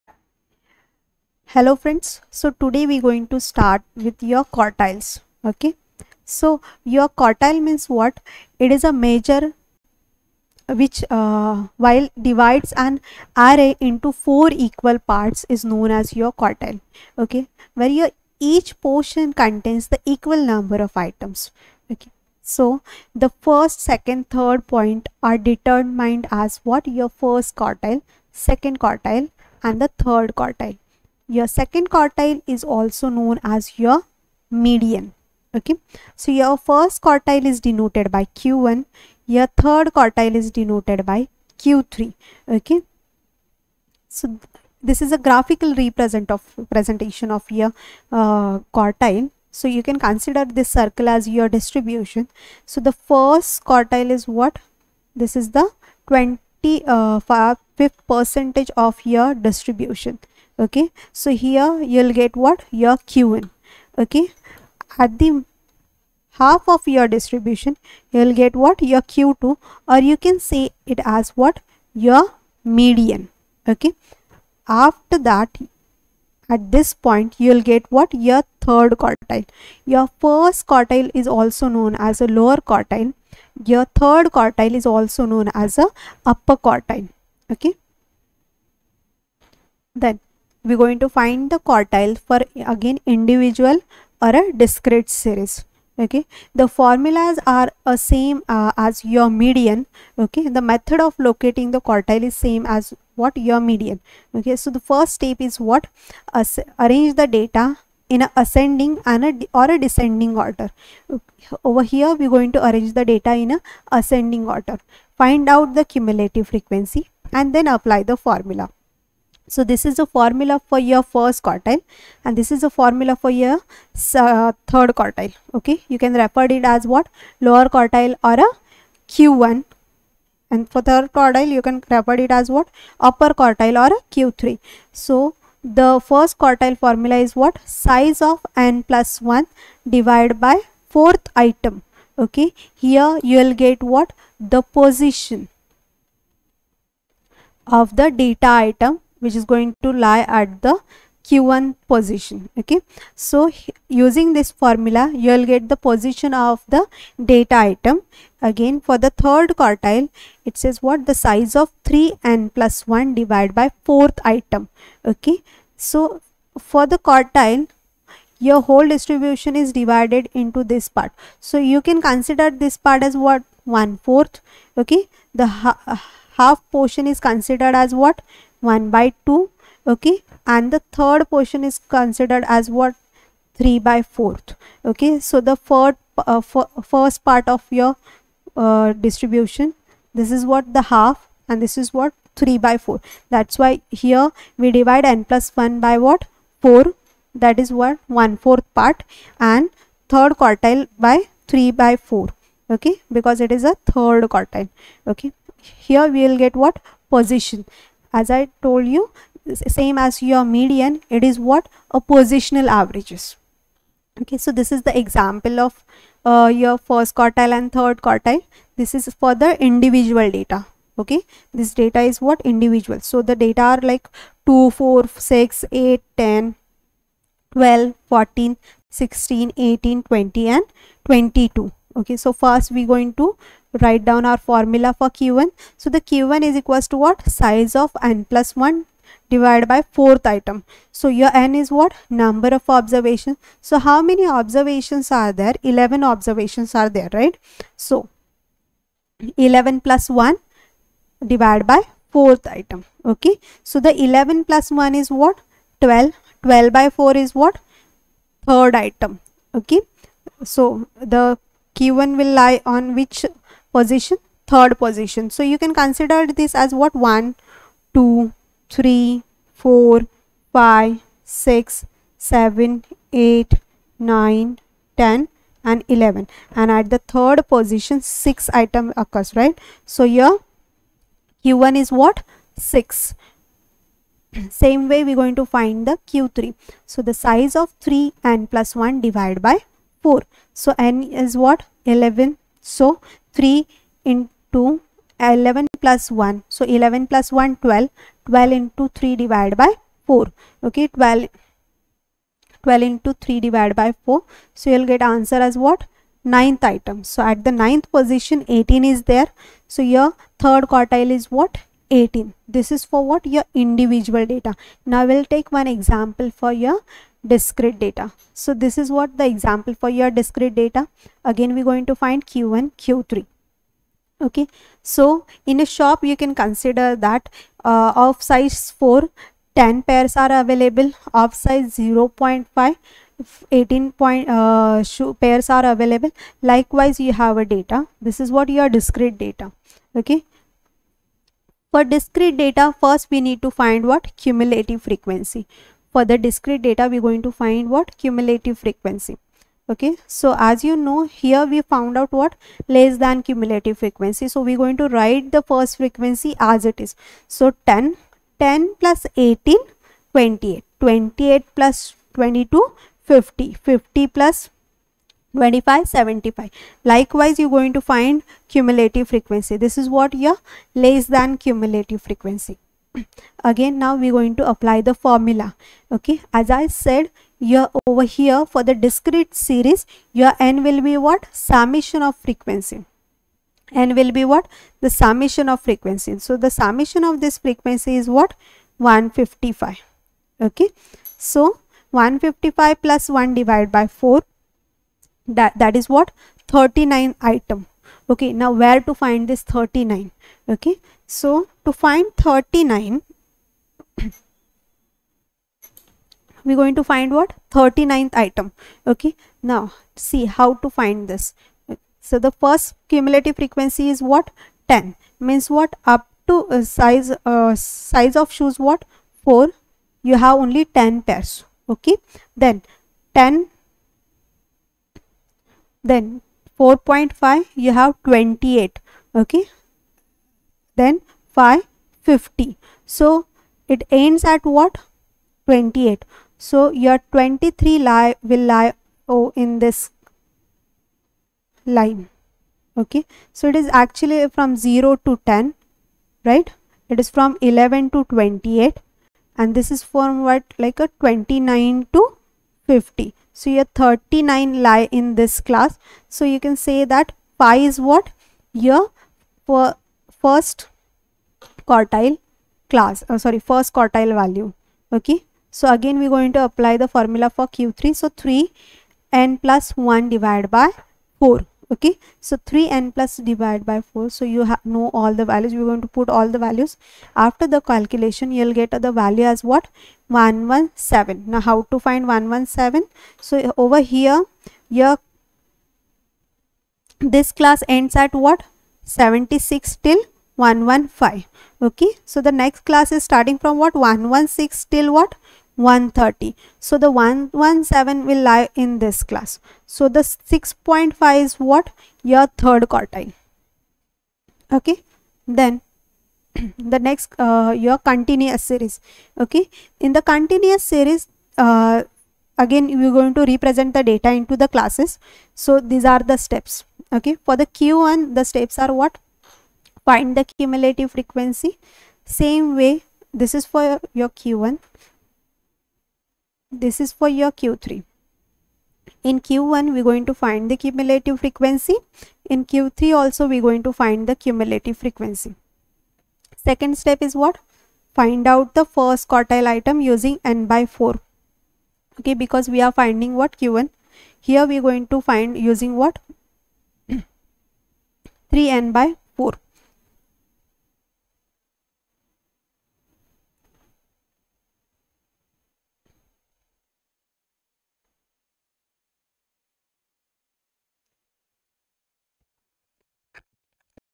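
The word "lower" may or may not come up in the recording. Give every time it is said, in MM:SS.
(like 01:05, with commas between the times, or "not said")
01:22, 02:07.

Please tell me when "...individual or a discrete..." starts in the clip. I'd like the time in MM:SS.
01:33.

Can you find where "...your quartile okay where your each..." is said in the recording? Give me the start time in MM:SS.
00:16.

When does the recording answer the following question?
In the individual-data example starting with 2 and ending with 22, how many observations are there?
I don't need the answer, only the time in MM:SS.
04:05.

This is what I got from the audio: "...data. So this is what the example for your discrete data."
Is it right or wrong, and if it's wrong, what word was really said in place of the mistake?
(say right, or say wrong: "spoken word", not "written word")
right.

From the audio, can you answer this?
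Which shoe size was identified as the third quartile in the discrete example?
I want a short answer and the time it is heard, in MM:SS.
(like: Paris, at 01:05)
6.5, at 08:20.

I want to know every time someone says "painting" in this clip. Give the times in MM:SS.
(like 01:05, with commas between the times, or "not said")
not said.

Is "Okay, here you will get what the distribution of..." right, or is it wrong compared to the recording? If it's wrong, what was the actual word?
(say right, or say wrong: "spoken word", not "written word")
wrong: "position", not "distribution".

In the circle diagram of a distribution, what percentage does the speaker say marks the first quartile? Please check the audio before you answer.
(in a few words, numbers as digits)
20 percent.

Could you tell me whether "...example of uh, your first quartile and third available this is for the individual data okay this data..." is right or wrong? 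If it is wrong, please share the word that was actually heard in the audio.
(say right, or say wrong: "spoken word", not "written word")
wrong: "quartile", not "available".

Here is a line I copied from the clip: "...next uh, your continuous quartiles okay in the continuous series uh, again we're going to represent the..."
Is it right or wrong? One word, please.
wrong.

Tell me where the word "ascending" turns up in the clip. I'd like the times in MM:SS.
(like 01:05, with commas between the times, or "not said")
01:48, 01:53.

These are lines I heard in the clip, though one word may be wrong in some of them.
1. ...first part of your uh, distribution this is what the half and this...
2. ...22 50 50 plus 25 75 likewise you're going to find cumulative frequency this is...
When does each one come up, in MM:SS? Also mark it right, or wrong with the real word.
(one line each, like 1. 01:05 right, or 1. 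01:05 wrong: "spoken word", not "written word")
1. 03:06 right
2. 06:02 right.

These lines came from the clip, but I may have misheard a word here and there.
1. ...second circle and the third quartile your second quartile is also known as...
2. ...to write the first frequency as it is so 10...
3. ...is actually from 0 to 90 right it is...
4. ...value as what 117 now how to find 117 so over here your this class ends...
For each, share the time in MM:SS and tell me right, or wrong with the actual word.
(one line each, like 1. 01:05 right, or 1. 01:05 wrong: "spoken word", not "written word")
1. 00:28 wrong: "quartile", not "circle"
2. 05:54 right
3. 07:23 wrong: "10", not "90"
4. 07:58 right.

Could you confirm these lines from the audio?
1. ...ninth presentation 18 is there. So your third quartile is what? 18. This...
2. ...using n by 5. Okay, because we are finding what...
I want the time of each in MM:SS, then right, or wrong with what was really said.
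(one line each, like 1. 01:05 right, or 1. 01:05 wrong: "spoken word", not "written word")
1. 05:07 wrong: "position", not "presentation"
2. 08:59 wrong: "4", not "5".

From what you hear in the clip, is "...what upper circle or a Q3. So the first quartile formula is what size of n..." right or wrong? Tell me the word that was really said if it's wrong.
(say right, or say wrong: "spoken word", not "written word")
wrong: "quartile", not "circle".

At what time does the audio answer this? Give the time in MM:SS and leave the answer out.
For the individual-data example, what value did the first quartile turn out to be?
04:41.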